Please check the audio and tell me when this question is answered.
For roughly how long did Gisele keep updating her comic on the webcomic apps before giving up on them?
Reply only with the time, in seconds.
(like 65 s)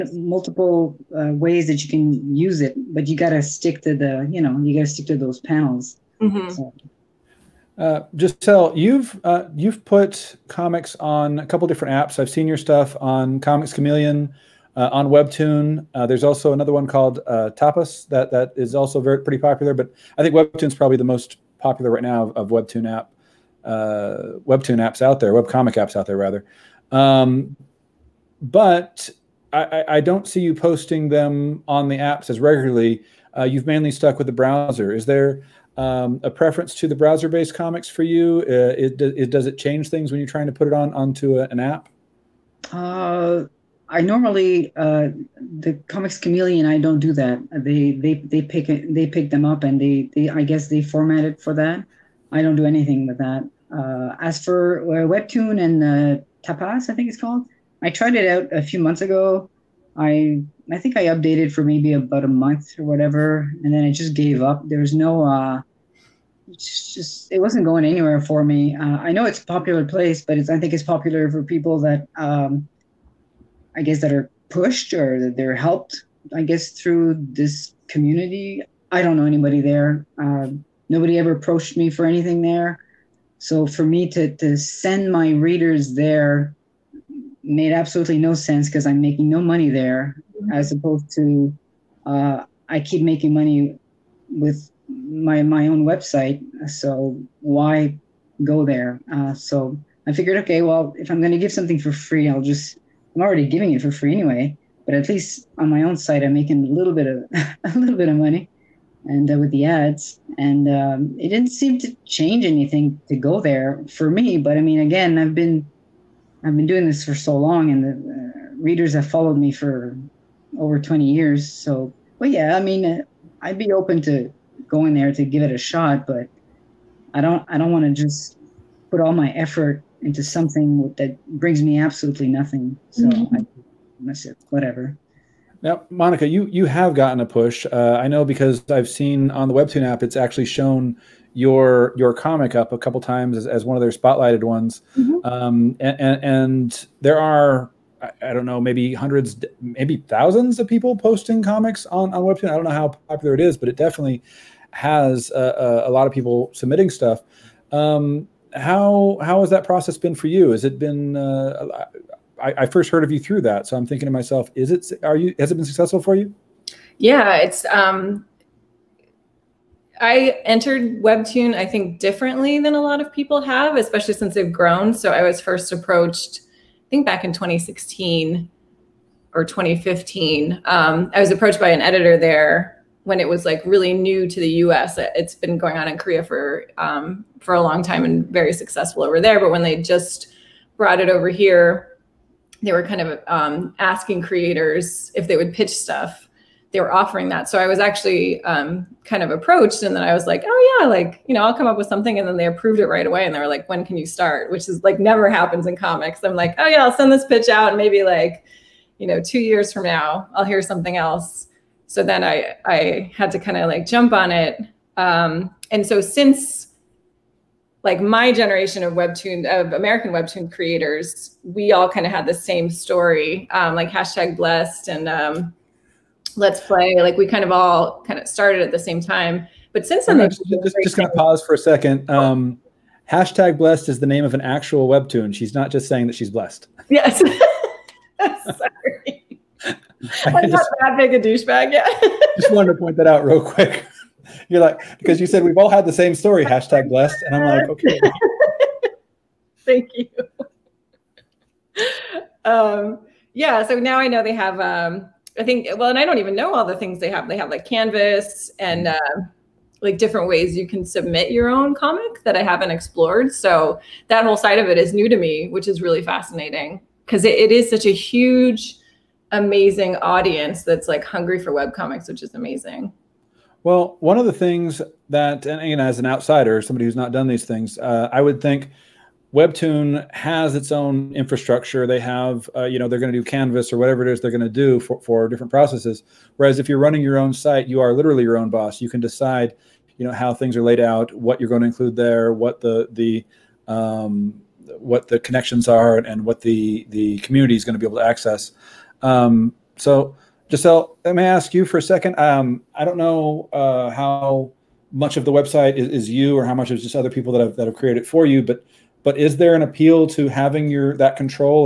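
61 s.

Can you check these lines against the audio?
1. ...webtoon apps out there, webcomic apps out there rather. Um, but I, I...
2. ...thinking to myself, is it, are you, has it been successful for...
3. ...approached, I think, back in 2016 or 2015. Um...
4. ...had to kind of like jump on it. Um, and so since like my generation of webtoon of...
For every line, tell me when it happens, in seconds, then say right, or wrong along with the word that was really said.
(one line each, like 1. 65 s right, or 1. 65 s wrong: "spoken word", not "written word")
1. 24 s right
2. 163 s right
3. 175 s right
4. 213 s right.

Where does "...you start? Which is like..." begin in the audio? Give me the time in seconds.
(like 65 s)
203 s.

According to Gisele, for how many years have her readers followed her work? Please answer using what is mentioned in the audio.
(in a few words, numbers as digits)
over 20 years.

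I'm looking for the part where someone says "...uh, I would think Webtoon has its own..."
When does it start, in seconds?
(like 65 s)
277 s.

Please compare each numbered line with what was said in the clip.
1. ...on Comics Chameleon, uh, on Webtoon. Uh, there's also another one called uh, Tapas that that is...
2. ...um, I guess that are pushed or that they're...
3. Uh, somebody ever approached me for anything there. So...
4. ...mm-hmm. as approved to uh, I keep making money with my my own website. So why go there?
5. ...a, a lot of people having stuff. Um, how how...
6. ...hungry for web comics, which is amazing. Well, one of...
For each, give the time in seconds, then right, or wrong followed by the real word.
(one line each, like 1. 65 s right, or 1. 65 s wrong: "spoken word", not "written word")
1. 13 s right
2. 72 s right
3. 80 s wrong: "nobody", not "somebody"
4. 90 s wrong: "opposed", not "approved"
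5. 155 s wrong: "submitting", not "having"
6. 271 s right.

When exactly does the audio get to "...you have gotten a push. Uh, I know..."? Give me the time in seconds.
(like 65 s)
136 s.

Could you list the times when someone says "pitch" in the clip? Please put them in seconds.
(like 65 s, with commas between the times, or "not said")
195 s, 207 s.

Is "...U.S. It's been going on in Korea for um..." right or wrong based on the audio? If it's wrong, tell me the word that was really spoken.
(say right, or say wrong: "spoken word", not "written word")
right.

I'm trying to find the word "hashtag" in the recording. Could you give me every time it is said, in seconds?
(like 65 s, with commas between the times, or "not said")
223 s, 233 s, 246 s.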